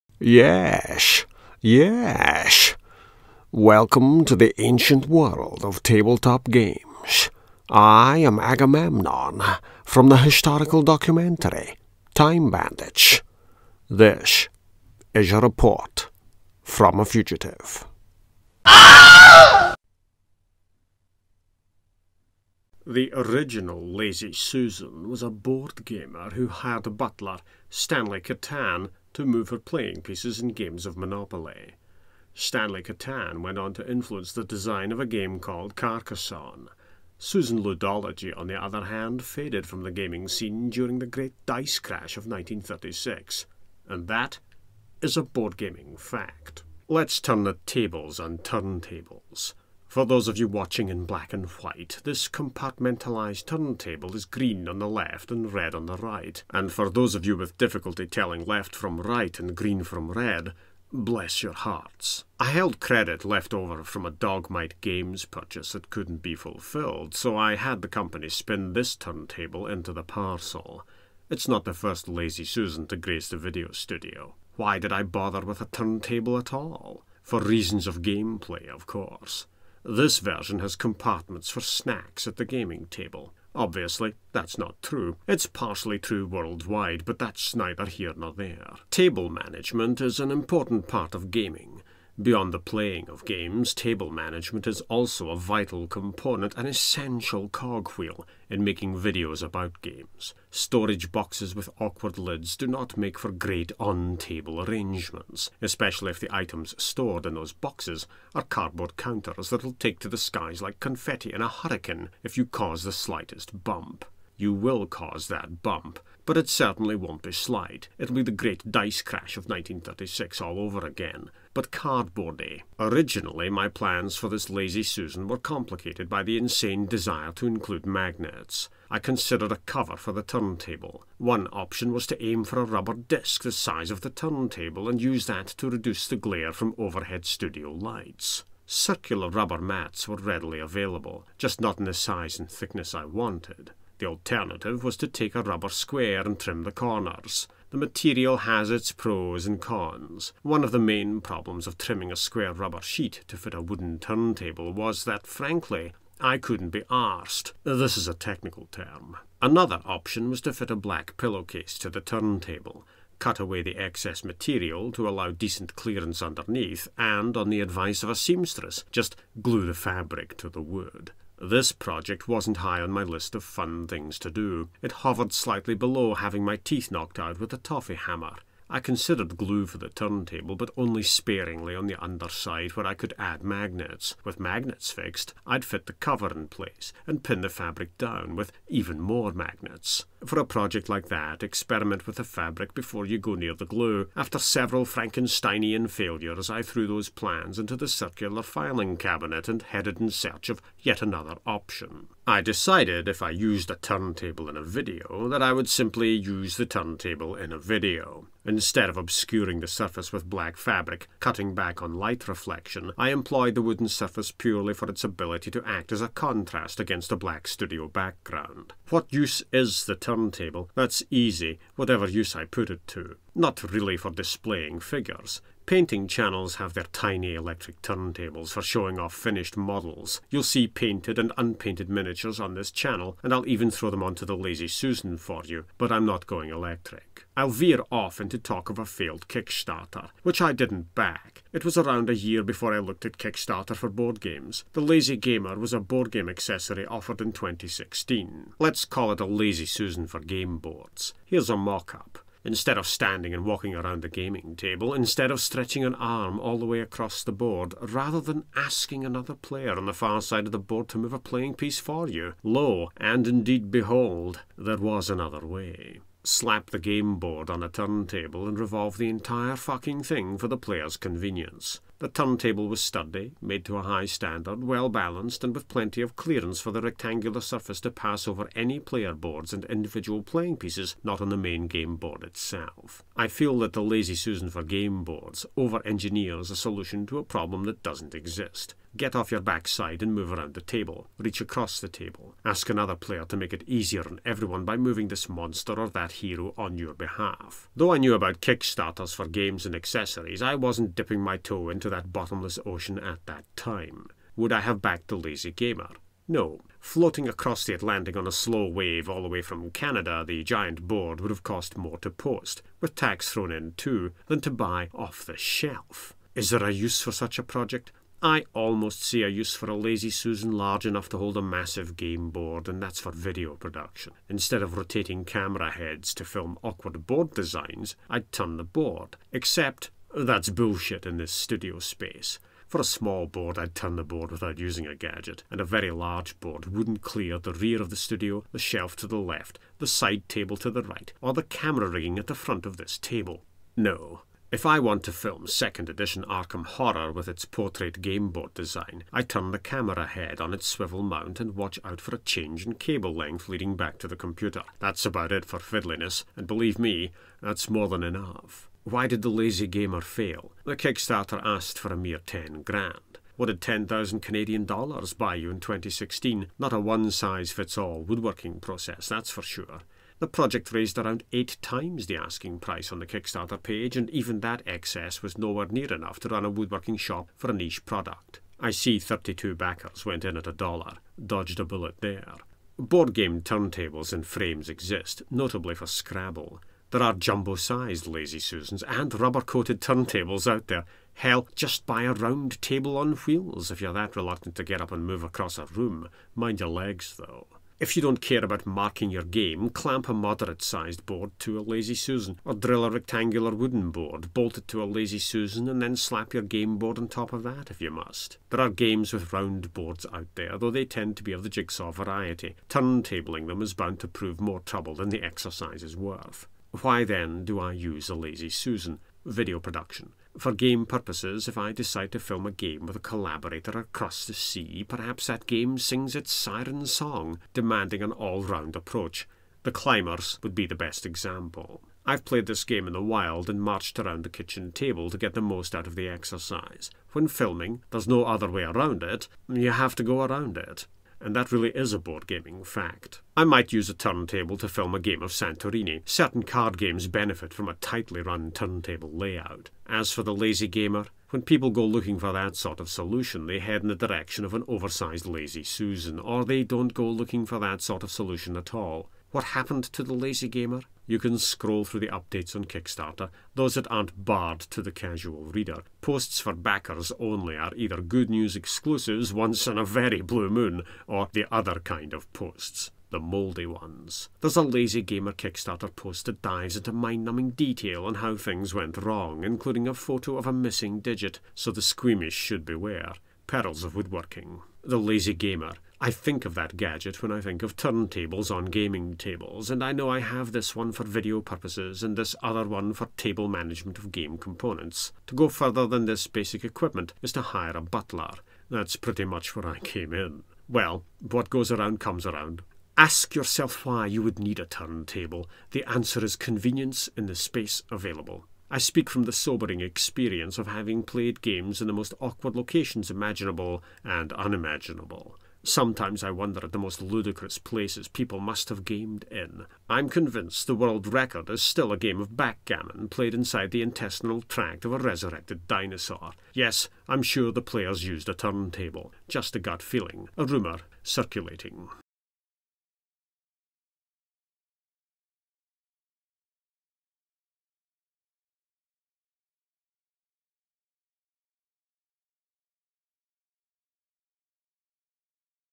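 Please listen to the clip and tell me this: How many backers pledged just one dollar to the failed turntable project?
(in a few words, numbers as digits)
32.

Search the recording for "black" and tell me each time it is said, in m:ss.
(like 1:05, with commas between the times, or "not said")
0:51, 2:40, 3:30, 3:37.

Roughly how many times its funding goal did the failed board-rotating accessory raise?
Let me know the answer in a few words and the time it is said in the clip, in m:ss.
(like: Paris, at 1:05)
8 times, at 6:11.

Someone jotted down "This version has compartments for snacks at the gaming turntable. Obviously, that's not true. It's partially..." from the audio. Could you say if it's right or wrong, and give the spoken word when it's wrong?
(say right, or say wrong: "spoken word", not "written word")
wrong: "table", not "turntable".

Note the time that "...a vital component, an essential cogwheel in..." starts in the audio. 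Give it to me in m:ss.
1:35.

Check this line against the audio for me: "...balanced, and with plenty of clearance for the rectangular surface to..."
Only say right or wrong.
right.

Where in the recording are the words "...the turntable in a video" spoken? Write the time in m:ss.
3:26.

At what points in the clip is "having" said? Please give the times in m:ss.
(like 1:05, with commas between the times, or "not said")
2:56, 8:30.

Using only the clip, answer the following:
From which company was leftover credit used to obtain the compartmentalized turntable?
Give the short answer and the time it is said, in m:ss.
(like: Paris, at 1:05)
Dogmight Games, at 1:04.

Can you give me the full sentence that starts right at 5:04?
Would I have backed the lazy gamer?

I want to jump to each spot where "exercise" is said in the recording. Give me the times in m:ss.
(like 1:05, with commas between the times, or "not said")
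6:55, 7:16.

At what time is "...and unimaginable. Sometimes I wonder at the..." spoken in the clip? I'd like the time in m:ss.
8:34.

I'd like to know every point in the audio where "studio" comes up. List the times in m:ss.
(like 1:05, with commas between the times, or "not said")
1:13, 2:17, 3:37, 5:31, 5:37.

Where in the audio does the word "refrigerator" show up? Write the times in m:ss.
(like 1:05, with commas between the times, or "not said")
not said.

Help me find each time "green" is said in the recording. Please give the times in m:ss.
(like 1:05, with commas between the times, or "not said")
0:54, 0:59.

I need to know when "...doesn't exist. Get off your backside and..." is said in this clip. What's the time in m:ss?
4:47.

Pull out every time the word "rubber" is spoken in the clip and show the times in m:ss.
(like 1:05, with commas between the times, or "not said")
2:12, 2:19, 2:25, 2:32, 6:29.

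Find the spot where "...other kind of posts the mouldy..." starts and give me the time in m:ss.
7:51.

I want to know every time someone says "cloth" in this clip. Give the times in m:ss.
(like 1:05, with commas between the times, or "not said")
not said.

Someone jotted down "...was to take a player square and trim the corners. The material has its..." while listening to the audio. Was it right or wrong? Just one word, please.
wrong.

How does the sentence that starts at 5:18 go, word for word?
I almost see a use for a lazy Susan large enough to hold a massive game board, and that's for video production.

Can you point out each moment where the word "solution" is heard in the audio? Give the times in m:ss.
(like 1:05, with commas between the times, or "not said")
4:46, 7:32, 7:38.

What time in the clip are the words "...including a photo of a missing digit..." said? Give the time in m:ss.
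7:59.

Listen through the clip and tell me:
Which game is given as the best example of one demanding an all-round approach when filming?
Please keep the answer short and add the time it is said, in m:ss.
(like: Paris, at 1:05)
The Climbers, at 7:09.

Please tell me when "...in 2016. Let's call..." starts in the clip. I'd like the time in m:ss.
4:07.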